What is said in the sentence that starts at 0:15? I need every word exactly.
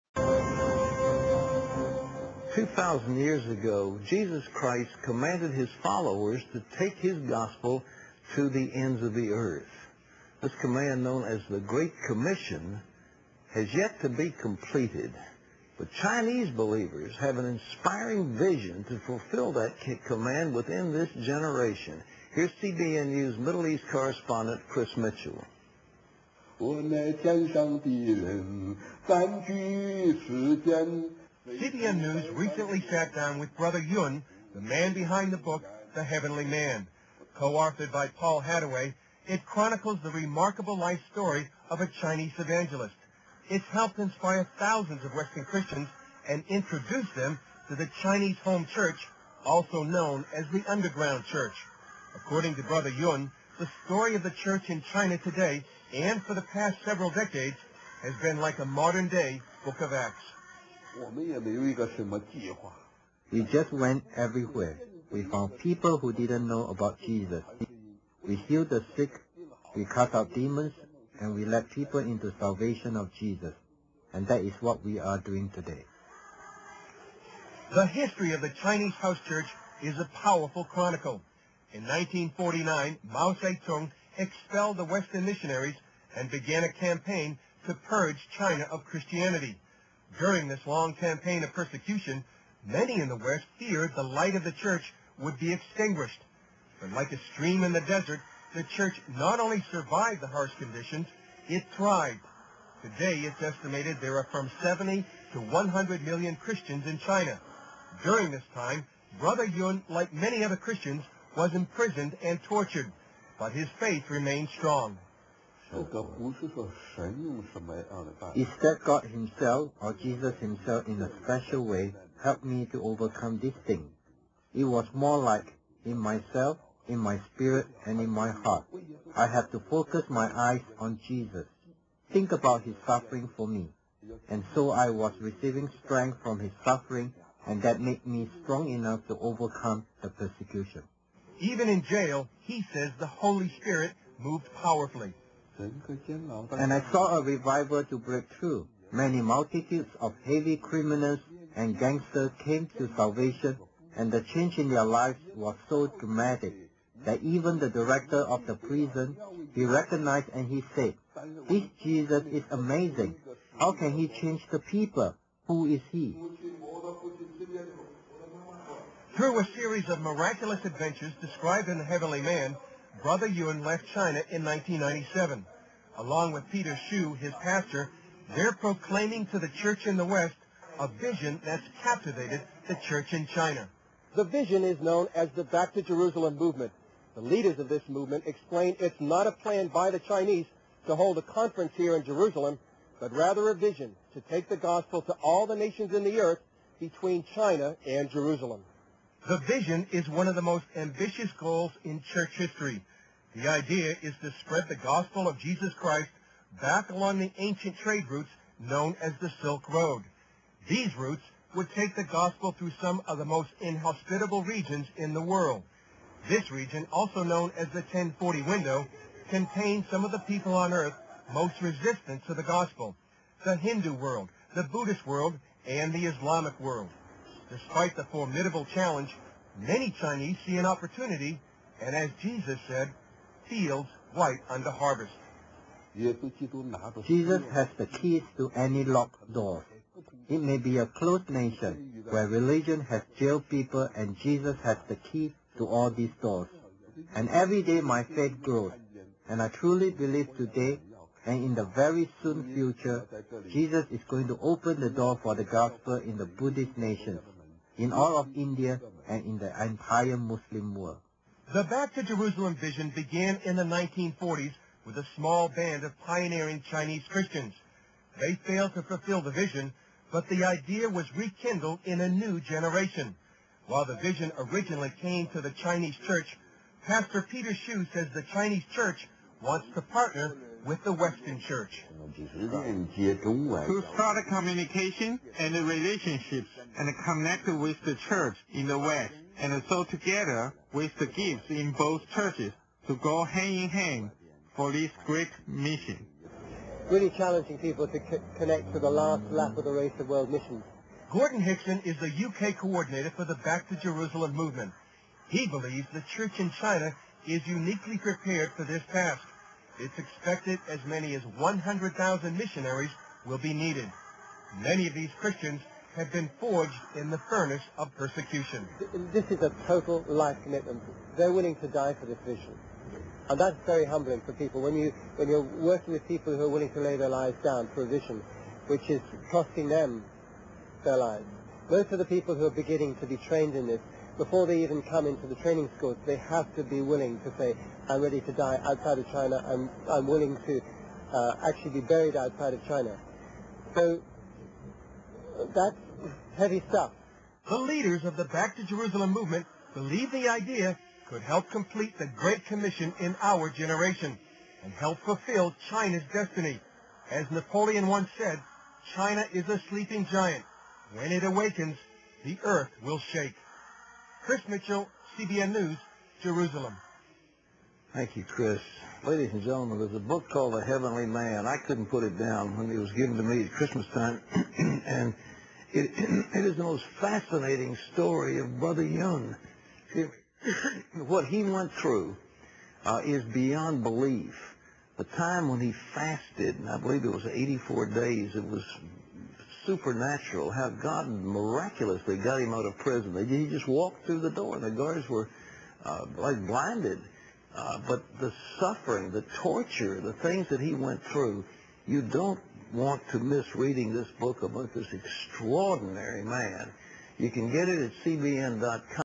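But Chinese believers have an inspiring vision to fulfill that command within this generation.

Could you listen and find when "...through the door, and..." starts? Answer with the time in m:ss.
6:34.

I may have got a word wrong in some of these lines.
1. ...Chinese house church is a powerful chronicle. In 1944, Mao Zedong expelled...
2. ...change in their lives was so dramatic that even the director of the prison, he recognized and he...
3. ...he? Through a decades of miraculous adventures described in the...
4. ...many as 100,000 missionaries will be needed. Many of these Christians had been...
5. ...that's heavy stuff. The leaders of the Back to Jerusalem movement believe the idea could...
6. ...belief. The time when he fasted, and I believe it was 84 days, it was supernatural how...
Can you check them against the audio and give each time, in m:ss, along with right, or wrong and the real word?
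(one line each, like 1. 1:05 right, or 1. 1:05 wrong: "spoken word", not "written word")
1. 1:18 wrong: "1949", not "1944"
2. 2:34 right
3. 2:45 wrong: "series", not "decades"
4. 5:10 right
5. 5:45 right
6. 6:23 right.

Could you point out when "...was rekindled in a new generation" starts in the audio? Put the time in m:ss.
4:30.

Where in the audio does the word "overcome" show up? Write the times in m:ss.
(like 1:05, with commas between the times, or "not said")
2:02, 2:19.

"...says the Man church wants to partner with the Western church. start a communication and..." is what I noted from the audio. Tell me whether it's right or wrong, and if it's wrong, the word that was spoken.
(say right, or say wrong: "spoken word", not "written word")
wrong: "Chinese", not "Man".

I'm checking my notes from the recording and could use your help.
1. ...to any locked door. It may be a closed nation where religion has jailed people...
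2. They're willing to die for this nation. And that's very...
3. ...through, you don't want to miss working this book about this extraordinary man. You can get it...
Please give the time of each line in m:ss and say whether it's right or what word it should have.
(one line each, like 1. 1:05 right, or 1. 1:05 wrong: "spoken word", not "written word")
1. 3:58 right
2. 5:21 wrong: "vision", not "nation"
3. 6:41 wrong: "reading", not "working".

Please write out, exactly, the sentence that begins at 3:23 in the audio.
The idea is to spread the gospel of Jesus Christ back along the ancient trade routes known as the Silk Road.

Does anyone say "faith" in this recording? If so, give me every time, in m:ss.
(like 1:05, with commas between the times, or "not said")
1:53, 4:08.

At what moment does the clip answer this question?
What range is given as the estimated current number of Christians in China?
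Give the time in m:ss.
1:44.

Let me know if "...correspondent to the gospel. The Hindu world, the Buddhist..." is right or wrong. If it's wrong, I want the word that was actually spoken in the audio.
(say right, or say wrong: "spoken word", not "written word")
wrong: "resistant", not "correspondent".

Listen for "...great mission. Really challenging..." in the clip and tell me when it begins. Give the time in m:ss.
4:55.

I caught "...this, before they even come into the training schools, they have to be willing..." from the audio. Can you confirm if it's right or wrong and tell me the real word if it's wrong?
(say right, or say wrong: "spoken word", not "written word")
right.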